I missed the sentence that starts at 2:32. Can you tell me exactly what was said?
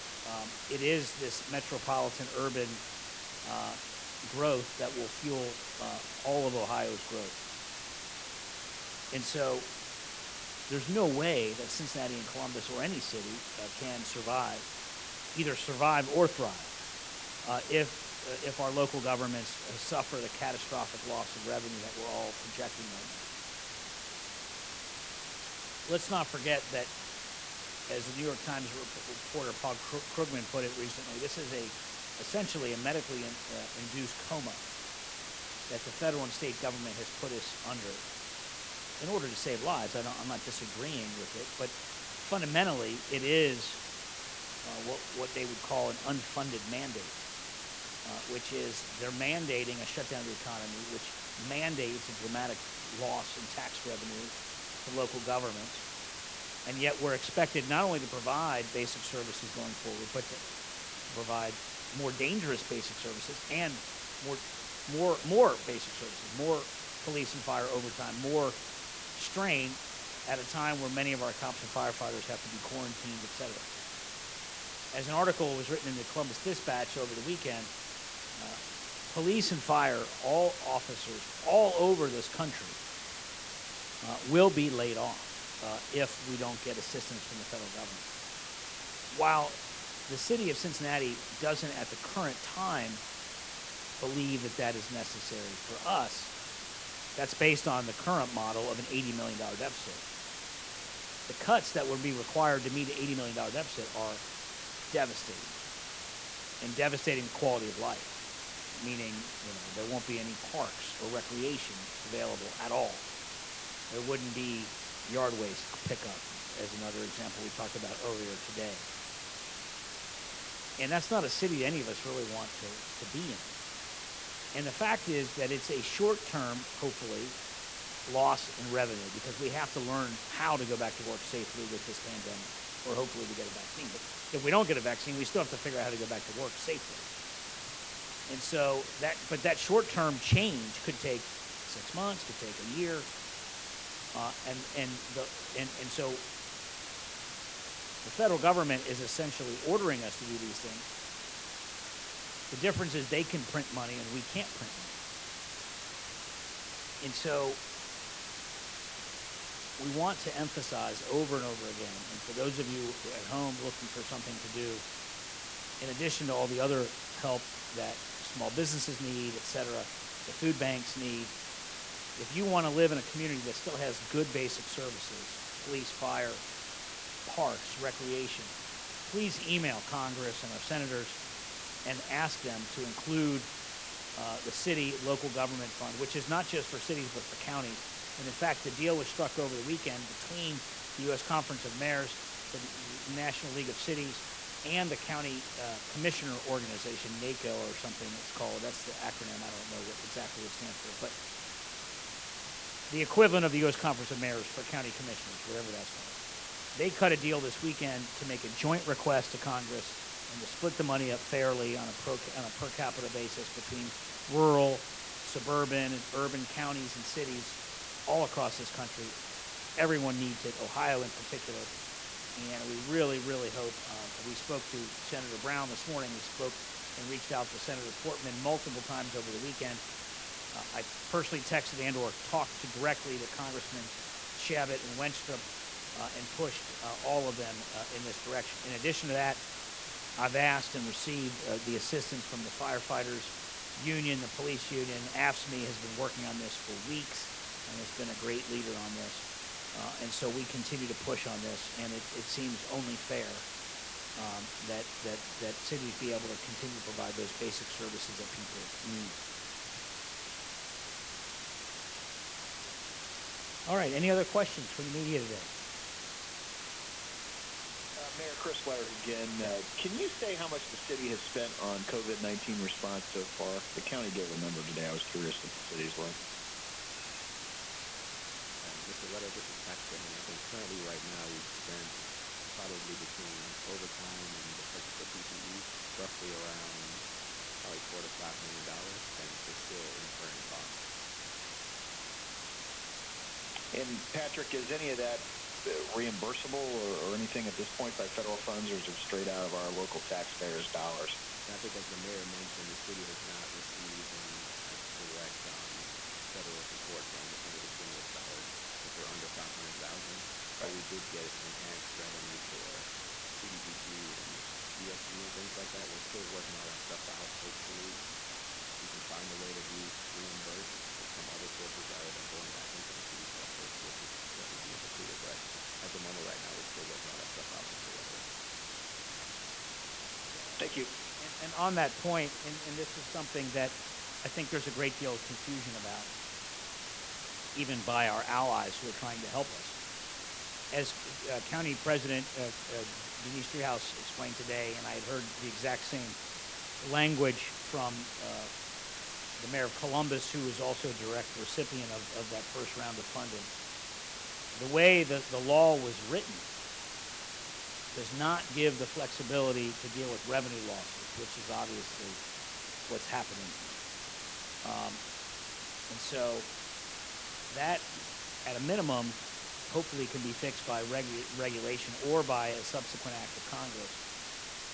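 The difference is they can print money and we can't print money.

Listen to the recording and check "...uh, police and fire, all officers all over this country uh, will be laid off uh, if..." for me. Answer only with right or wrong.
right.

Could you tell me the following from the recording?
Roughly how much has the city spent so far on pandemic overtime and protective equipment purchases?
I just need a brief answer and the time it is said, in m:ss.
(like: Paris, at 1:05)
4 to 5 million dollars, at 4:47.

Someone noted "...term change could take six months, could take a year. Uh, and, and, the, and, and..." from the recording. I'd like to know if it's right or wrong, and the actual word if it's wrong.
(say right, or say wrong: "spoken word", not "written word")
right.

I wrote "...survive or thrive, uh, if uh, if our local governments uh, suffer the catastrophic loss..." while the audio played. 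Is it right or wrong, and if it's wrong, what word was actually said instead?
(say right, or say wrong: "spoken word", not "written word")
right.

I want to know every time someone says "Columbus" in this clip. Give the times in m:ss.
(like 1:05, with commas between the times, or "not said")
0:12, 1:16, 5:49.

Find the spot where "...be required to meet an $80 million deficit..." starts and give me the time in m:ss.
1:41.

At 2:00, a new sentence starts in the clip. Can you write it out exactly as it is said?
And that's not a city any of us really want to, to be in.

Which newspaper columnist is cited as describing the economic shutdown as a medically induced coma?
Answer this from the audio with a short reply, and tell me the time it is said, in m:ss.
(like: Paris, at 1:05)
Paul Krugman, at 0:29.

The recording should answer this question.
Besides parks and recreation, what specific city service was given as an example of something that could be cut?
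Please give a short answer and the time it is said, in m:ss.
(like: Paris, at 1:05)
Yard waste pickup, at 1:55.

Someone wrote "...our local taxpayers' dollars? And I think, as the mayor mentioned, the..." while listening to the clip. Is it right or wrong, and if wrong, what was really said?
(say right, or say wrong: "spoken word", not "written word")
right.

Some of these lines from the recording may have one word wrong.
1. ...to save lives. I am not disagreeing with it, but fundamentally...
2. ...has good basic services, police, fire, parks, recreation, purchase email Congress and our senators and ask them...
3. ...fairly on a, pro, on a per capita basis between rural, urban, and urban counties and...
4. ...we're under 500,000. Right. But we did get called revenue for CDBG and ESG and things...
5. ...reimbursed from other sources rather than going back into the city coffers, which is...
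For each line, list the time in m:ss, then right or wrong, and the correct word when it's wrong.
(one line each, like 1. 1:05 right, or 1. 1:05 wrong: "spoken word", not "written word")
1. 0:39 right
2. 2:53 wrong: "please", not "purchase"
3. 3:31 wrong: "suburban", not "urban"
4. 5:08 wrong: "enhanced", not "called"
5. 5:20 right.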